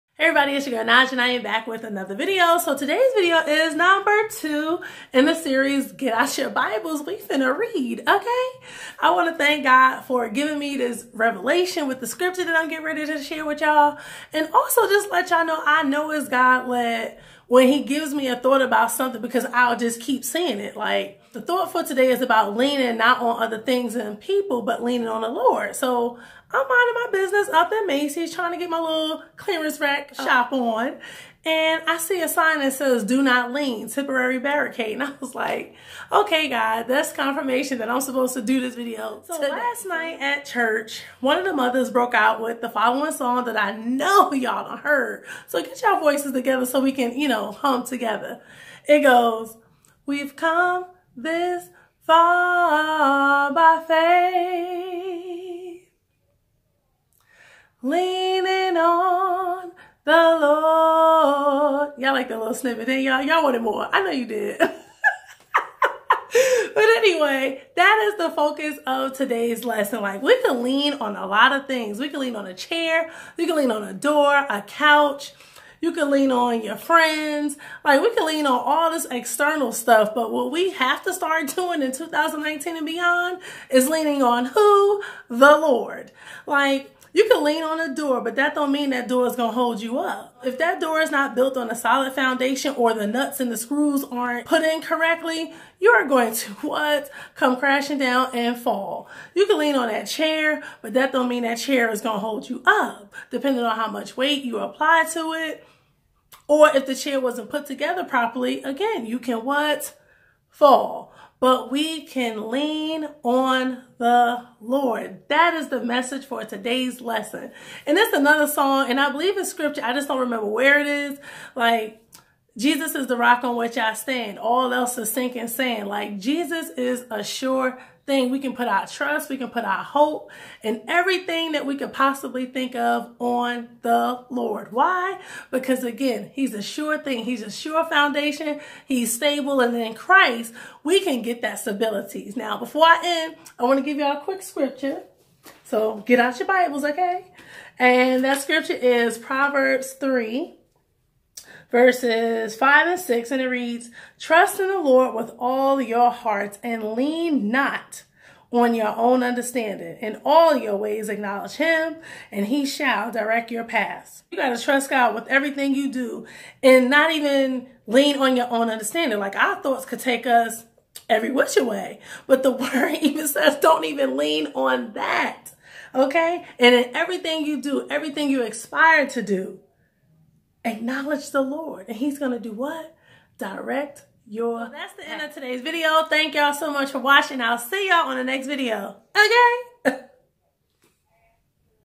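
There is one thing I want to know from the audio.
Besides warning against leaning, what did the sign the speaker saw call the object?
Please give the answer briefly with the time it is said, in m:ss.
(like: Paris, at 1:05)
Temporary barricade, at 0:33.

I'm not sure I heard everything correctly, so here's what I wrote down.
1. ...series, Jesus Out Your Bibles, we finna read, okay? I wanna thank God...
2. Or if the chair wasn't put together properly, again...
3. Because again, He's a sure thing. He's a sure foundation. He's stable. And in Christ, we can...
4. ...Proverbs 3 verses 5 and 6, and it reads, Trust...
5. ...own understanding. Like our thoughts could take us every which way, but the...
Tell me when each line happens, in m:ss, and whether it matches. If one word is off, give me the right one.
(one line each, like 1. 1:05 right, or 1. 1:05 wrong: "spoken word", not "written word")
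1. 0:05 wrong: "Get", not "Jesus"
2. 1:46 right
3. 2:15 right
4. 2:29 right
5. 2:48 right.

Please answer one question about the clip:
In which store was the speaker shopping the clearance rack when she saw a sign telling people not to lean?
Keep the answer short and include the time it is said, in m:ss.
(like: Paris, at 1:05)
Macy's, at 0:27.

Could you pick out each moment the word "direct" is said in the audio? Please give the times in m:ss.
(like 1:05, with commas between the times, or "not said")
2:43, 3:03.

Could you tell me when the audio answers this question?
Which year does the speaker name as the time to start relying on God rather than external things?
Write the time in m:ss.
1:21.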